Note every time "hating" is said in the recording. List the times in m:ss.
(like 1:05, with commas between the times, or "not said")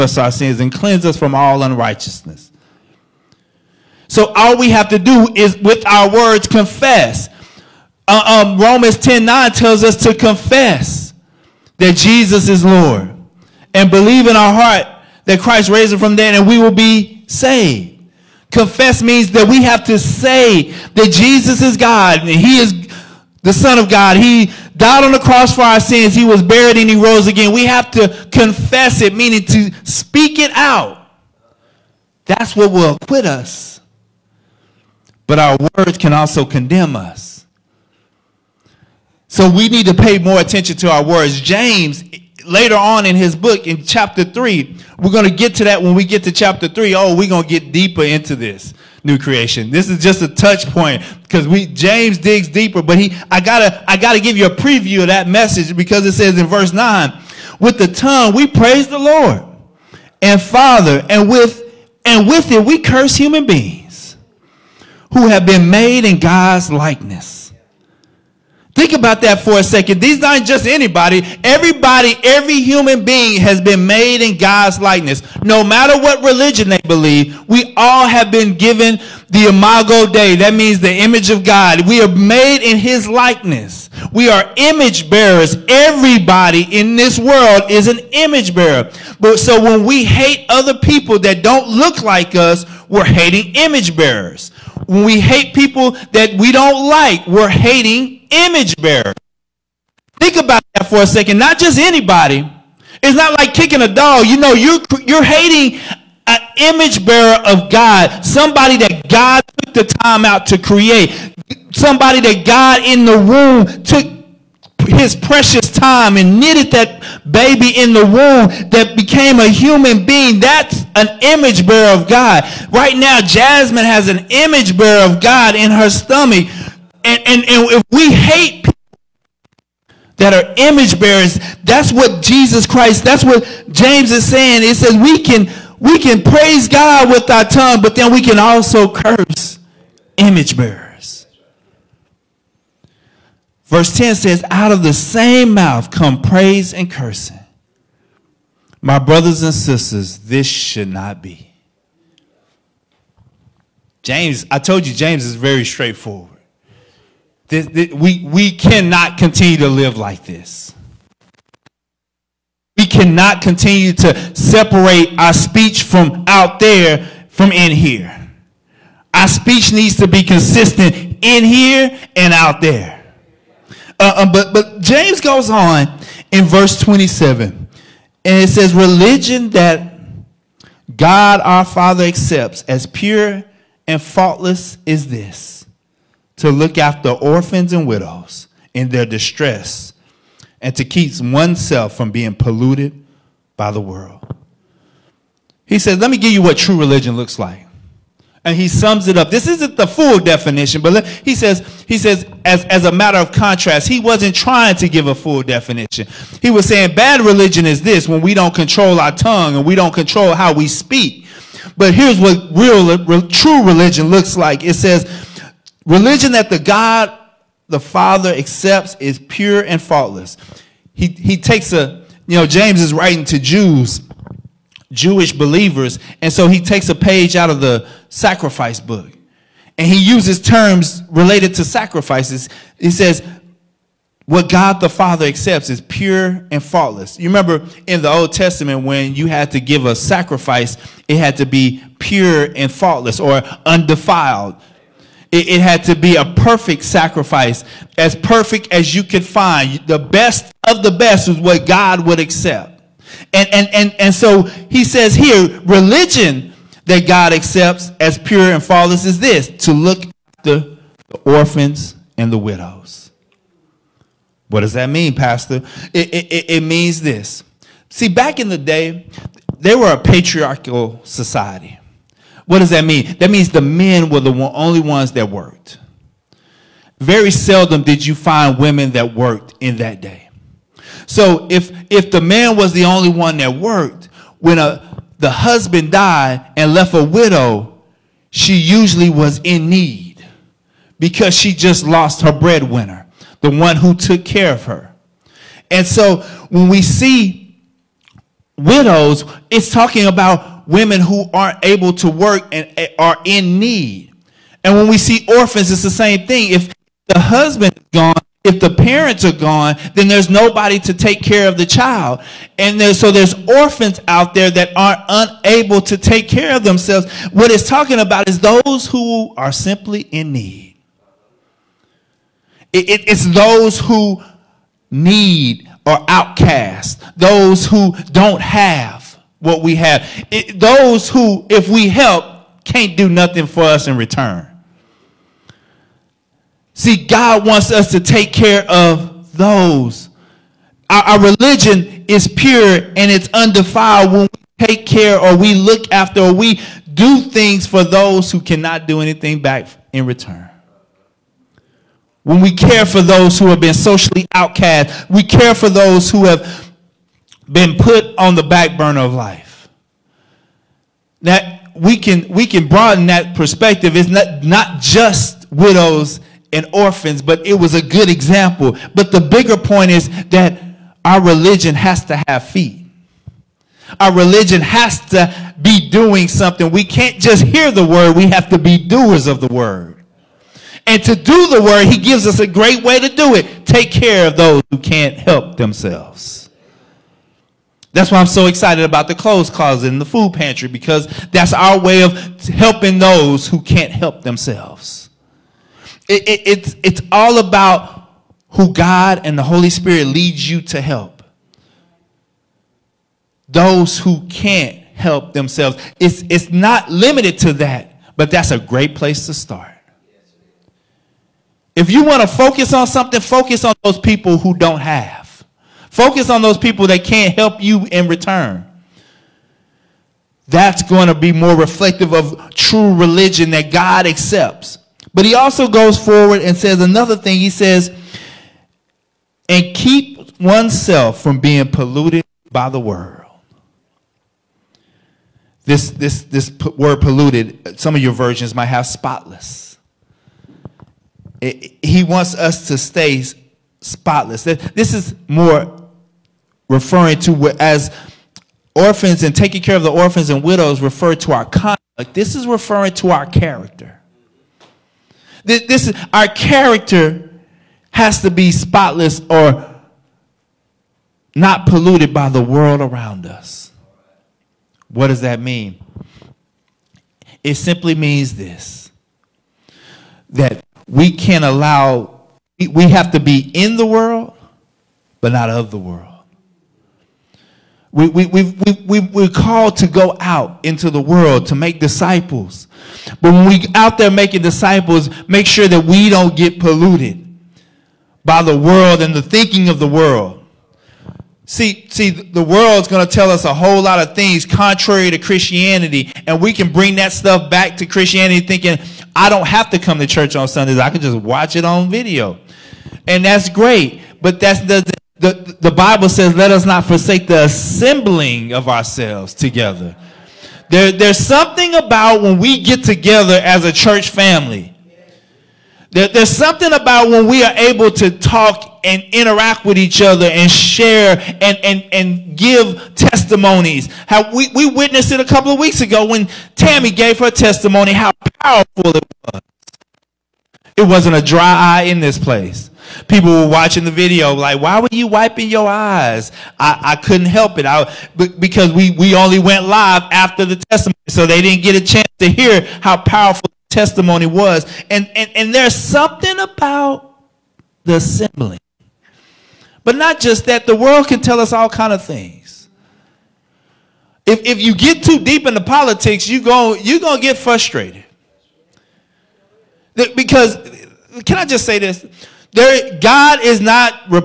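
1:33, 1:37, 1:45.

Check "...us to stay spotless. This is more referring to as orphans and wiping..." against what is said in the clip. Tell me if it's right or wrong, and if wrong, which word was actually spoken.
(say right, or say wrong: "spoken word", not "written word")
wrong: "taking", not "wiping".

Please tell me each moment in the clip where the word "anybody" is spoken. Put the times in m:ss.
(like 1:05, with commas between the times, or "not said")
1:10, 1:41.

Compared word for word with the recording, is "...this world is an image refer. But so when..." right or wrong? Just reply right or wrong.
wrong.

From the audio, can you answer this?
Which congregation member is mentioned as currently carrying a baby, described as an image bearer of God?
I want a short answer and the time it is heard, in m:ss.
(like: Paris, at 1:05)
Jasmine, at 2:03.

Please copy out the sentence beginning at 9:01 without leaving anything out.
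So they didn't get a chance to hear how powerful the testimony was.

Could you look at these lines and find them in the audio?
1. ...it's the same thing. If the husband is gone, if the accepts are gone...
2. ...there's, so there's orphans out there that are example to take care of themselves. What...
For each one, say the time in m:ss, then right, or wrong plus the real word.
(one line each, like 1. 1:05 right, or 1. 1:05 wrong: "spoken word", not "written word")
1. 5:05 wrong: "parents", not "accepts"
2. 5:12 wrong: "unable", not "example".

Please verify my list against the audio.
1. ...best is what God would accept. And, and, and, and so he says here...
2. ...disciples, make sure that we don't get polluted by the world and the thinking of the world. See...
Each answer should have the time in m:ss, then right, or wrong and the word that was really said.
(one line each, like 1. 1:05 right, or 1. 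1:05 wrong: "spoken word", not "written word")
1. 4:10 right
2. 8:04 right.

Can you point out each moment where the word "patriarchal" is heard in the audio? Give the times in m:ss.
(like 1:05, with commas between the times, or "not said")
4:29.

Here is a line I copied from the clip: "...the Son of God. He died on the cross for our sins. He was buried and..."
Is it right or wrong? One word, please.
right.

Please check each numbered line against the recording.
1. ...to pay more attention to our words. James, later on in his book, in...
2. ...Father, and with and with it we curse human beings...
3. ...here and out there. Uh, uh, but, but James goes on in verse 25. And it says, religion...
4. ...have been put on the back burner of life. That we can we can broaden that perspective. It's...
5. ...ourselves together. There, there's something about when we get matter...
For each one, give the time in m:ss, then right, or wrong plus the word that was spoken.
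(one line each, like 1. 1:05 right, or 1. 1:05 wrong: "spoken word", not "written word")
1. 0:39 right
2. 1:00 right
3. 2:51 wrong: "27", not "25"
4. 5:56 right
5. 8:28 wrong: "together", not "matter".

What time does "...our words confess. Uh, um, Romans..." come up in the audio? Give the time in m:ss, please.
0:05.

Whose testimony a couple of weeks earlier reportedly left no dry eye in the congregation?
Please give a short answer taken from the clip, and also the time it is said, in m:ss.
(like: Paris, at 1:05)
Tammy, at 8:46.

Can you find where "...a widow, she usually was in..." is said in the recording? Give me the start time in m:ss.
4:46.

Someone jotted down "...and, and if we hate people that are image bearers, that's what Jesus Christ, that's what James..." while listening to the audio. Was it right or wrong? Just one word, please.
right.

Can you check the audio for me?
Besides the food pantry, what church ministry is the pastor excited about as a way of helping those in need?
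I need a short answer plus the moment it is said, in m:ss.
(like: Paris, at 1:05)
clothes closet, at 6:29.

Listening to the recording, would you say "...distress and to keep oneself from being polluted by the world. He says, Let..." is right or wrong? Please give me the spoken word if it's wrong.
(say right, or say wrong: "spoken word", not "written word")
right.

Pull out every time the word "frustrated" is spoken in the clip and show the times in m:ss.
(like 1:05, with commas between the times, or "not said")
9:17.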